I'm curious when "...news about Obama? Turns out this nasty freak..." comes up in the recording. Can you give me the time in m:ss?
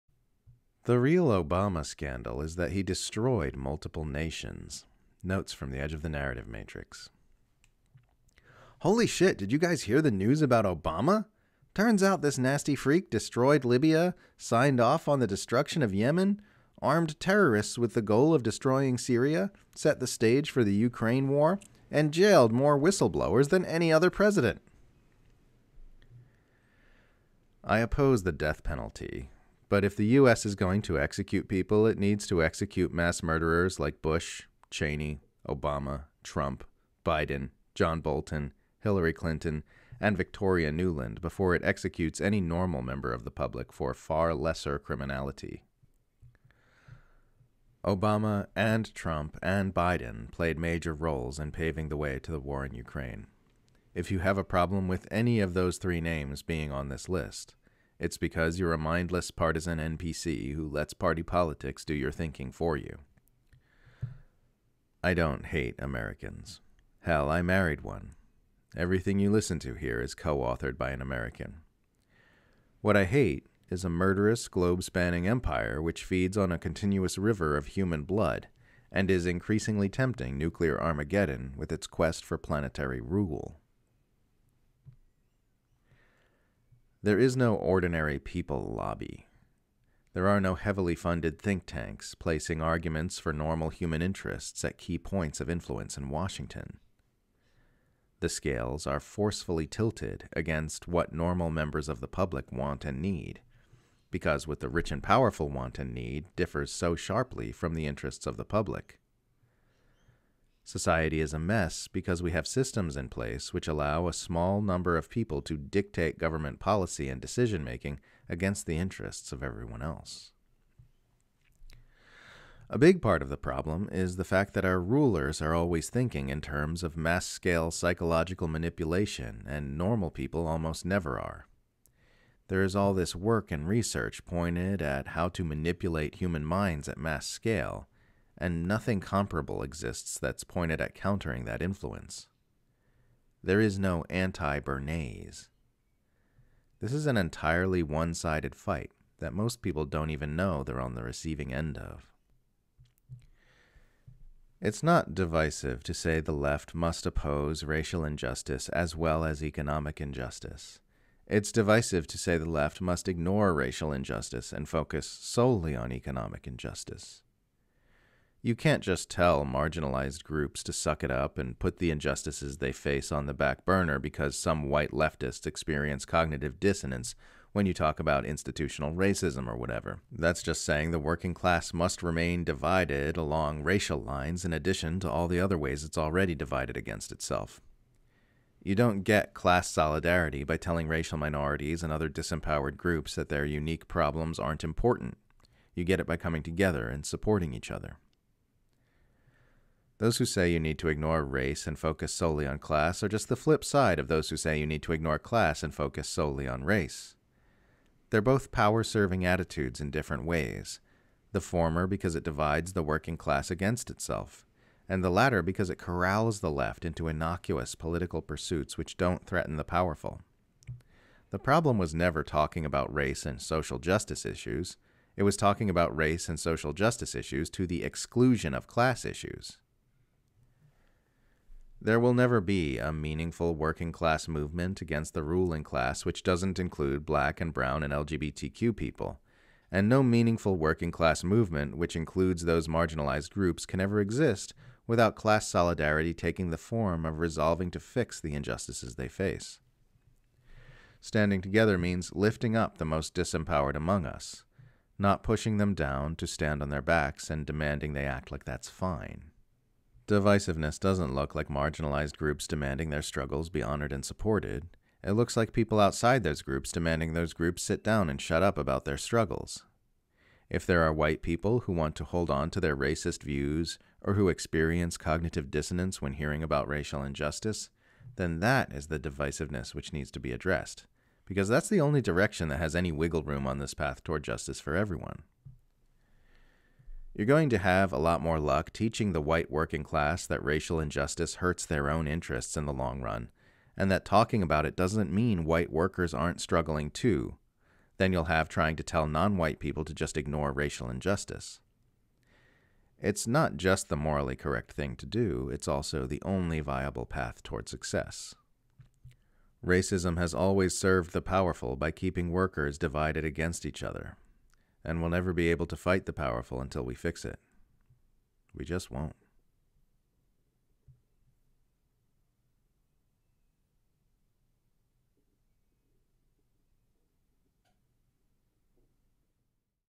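0:10.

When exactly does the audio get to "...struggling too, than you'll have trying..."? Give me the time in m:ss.
4:56.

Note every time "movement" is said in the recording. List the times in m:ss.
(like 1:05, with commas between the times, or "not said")
3:54, 4:01.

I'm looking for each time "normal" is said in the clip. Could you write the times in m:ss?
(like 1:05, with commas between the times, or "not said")
0:42, 1:33, 1:41, 2:09.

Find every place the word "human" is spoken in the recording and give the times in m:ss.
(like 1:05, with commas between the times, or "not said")
1:17, 1:33, 2:16.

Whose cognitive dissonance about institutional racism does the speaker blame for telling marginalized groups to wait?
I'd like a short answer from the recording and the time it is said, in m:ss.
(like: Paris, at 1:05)
white leftists, at 2:54.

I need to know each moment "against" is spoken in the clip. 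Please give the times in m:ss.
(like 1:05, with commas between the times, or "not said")
1:40, 1:58, 3:06, 3:33, 3:54, 5:13.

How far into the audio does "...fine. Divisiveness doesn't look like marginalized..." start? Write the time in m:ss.
4:18.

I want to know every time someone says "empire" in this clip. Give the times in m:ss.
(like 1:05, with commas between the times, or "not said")
1:15.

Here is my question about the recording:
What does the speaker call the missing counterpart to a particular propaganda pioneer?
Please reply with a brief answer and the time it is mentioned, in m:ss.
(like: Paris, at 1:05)
anti Bernays, at 2:24.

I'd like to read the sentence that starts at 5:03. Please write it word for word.
It's not just the morally correct thing to do, it's also the only viable path toward success.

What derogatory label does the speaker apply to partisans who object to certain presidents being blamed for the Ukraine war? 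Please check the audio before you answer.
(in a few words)
NPC.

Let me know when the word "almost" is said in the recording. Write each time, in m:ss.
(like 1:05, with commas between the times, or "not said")
2:10.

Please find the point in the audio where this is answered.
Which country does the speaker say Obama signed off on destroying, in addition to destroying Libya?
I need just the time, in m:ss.
0:15.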